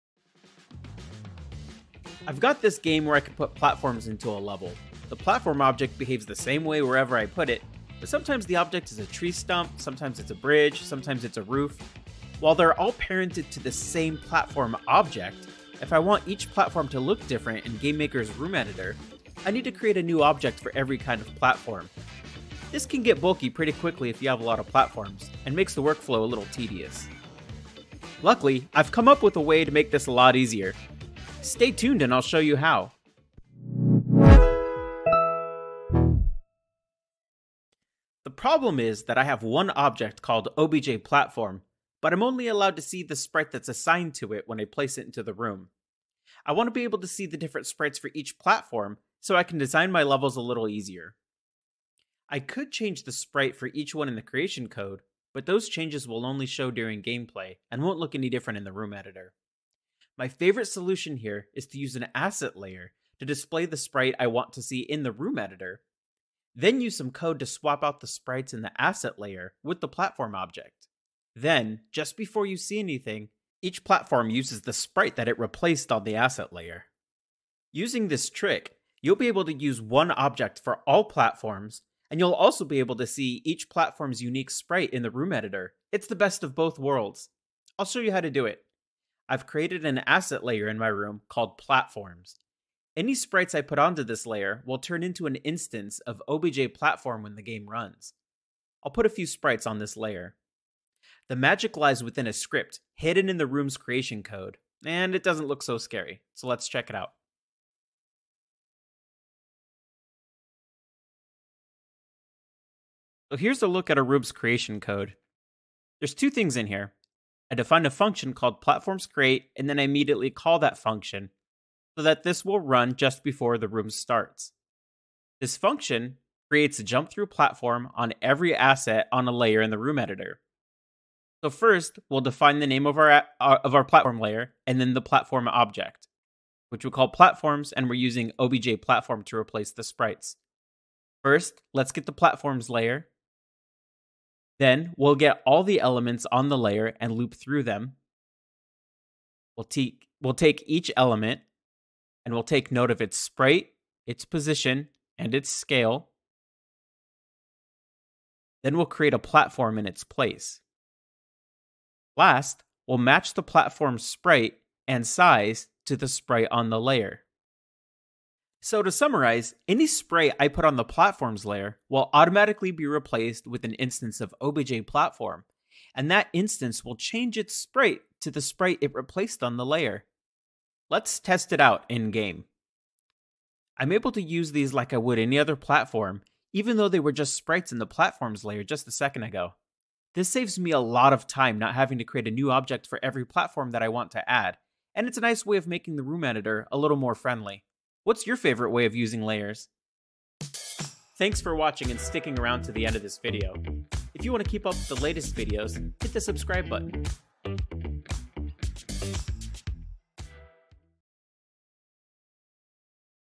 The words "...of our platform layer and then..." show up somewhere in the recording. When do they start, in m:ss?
2:13.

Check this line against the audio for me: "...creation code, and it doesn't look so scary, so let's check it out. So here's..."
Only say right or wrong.
right.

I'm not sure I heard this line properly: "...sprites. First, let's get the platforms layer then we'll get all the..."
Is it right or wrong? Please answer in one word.
right.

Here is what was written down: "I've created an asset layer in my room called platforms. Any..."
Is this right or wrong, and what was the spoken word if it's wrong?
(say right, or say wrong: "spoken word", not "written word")
right.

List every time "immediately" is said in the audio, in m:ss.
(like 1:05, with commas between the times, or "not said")
1:59.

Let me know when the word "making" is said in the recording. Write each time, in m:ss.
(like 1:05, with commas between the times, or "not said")
3:15.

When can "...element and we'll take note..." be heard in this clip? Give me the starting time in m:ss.
2:30.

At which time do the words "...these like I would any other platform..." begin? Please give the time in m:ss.
3:04.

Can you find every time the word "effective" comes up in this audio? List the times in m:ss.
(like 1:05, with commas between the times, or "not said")
not said.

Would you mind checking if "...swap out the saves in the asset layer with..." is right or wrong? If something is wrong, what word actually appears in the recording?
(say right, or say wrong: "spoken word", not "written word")
wrong: "sprites", not "saves".